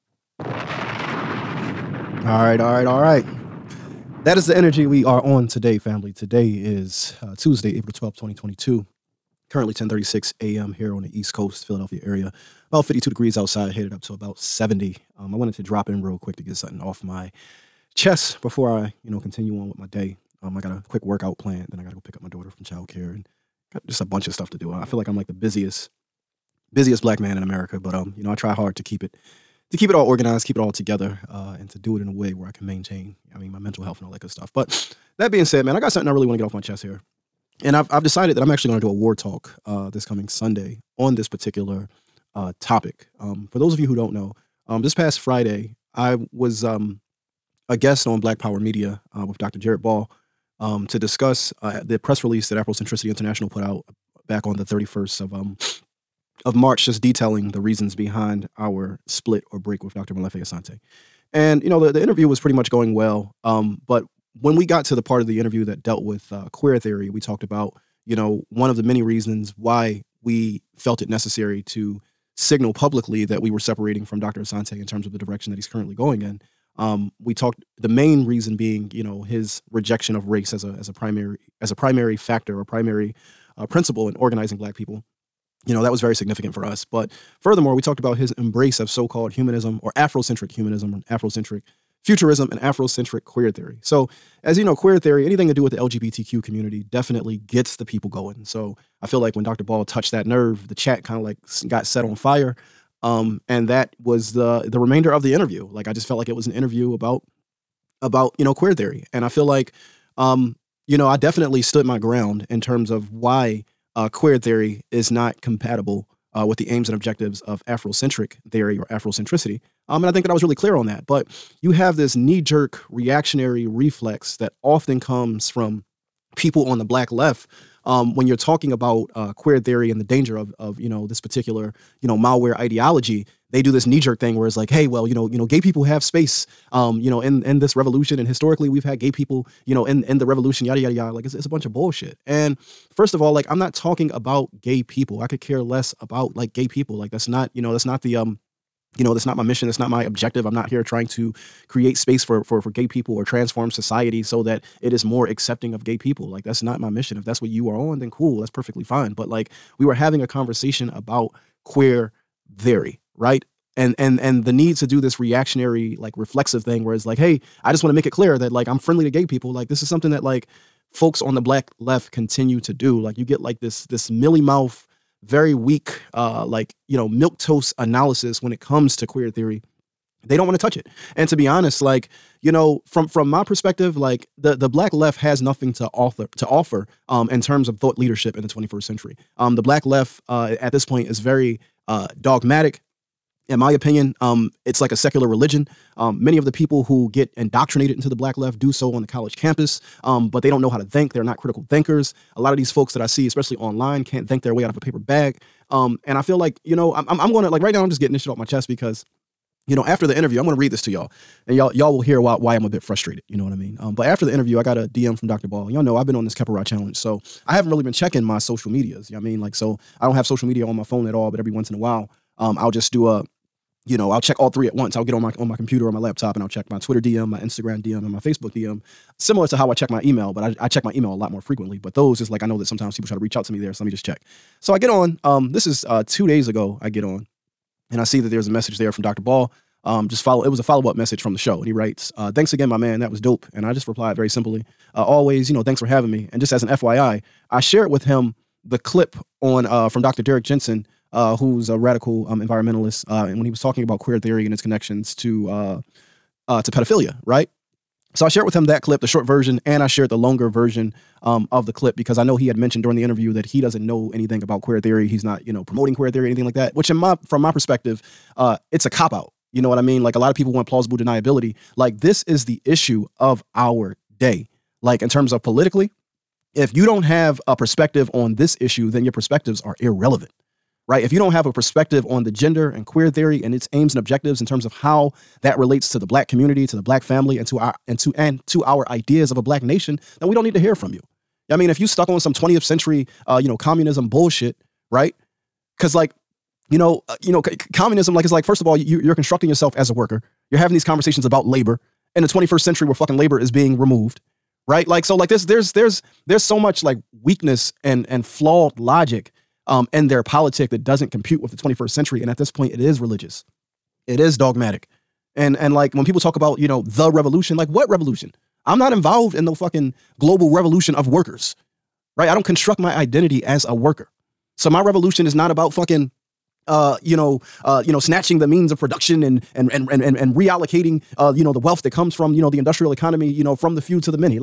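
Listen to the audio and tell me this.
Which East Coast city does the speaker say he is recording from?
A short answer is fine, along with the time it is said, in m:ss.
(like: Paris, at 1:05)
Philadelphia, at 0:11.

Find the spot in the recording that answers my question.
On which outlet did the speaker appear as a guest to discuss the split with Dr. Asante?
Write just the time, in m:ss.
0:48.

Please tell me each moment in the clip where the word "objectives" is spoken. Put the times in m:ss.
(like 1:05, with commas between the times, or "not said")
1:56, 2:30, 4:43.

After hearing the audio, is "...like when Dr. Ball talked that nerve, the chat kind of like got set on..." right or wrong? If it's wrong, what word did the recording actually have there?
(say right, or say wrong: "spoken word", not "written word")
wrong: "touched", not "talked".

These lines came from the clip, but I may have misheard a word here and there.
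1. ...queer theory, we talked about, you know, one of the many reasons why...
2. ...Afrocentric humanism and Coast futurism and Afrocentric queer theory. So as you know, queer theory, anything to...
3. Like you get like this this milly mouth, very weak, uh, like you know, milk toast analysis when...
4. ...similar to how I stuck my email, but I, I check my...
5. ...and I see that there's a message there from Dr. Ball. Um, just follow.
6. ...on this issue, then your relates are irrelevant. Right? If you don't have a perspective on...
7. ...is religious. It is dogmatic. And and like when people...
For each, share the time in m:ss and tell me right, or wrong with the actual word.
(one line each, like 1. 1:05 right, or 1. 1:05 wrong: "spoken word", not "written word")
1. 1:06 right
2. 1:29 wrong: "Afrocentric", not "Coast"
3. 2:53 right
4. 3:49 wrong: "check", not "stuck"
5. 3:57 right
6. 4:38 wrong: "perspectives", not "relates"
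7. 5:12 right.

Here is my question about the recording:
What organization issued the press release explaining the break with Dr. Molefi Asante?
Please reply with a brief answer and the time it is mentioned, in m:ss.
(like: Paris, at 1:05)
Afrocentricity International, at 0:52.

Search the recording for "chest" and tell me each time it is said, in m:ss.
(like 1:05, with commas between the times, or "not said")
0:17, 0:36, 3:28.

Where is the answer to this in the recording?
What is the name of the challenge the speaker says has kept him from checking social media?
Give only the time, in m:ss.
3:36.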